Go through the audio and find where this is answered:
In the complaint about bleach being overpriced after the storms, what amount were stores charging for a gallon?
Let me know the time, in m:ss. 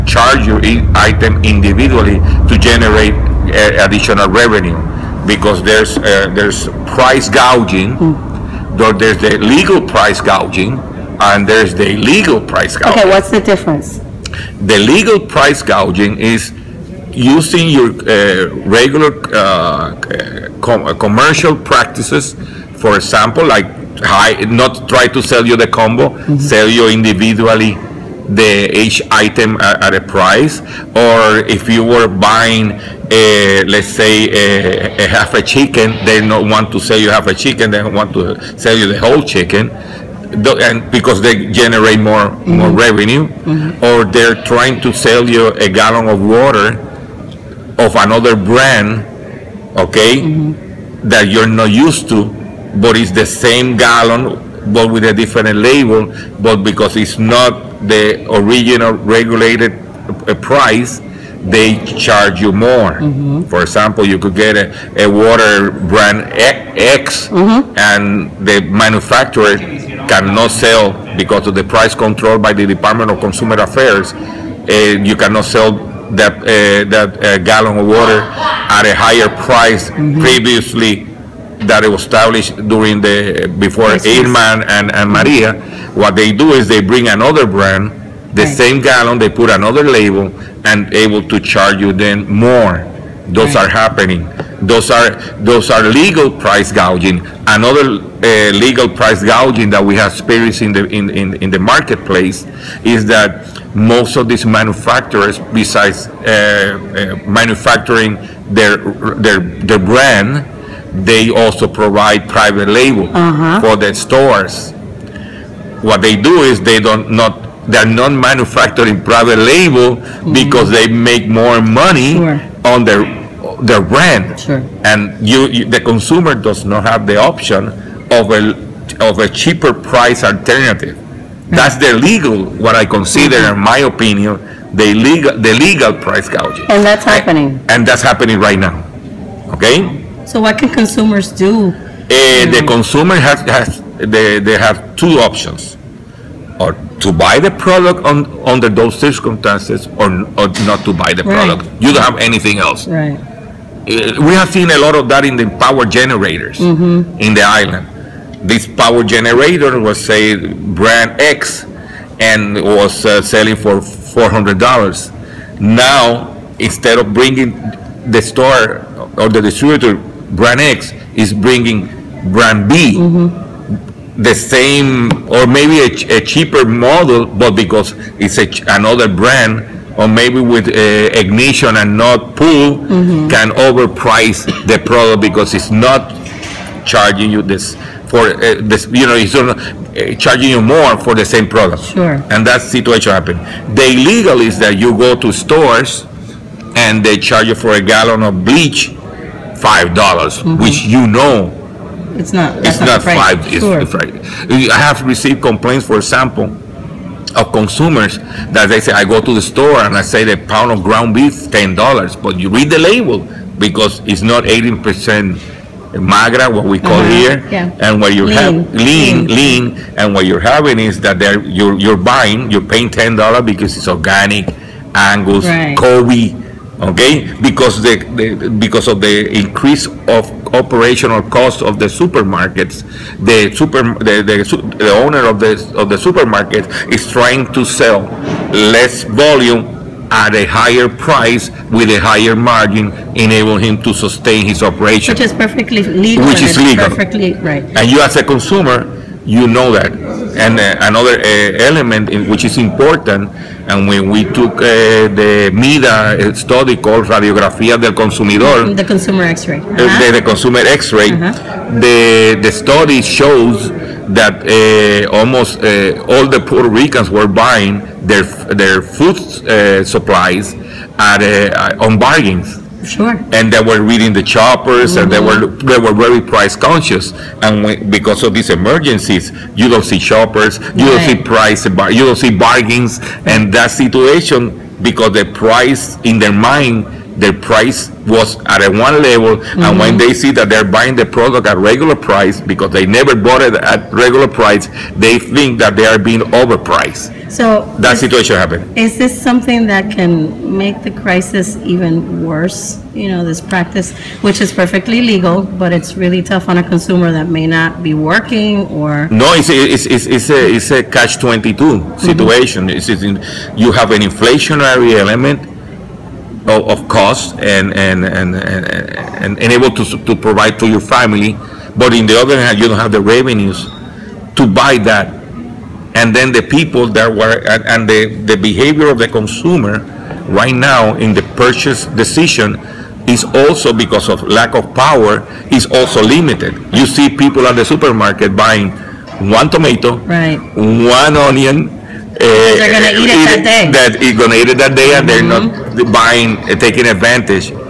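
3:19.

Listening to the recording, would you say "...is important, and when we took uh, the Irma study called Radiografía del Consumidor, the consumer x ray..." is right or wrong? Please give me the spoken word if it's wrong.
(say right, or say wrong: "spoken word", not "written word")
wrong: "MIDA", not "Irma".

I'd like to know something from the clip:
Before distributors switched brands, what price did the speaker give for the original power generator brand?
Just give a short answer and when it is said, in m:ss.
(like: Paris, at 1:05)
$400, at 2:43.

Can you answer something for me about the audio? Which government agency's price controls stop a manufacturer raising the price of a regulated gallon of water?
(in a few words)
Department of Consumer Affairs.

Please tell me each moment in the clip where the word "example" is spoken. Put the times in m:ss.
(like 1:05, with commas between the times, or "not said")
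0:22, 1:03, 3:25.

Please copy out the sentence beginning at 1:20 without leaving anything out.
previously that was established during the before Irma and, and Maria, what they do is they bring another brand, the right.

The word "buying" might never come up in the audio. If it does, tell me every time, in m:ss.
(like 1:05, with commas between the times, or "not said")
0:32, 3:42, 4:27, 4:50, 5:38, 5:45.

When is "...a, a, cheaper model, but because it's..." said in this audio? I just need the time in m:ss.
2:55.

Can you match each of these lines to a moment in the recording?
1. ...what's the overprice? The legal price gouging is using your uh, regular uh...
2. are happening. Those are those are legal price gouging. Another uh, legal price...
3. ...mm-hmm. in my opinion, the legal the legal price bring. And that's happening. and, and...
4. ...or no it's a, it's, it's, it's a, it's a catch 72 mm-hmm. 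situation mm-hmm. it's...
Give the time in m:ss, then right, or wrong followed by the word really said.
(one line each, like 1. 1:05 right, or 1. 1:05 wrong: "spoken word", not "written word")
1. 0:13 wrong: "difference", not "overprice"
2. 1:33 right
3. 2:13 wrong: "gouging", not "bring"
4. 5:08 wrong: "22", not "72".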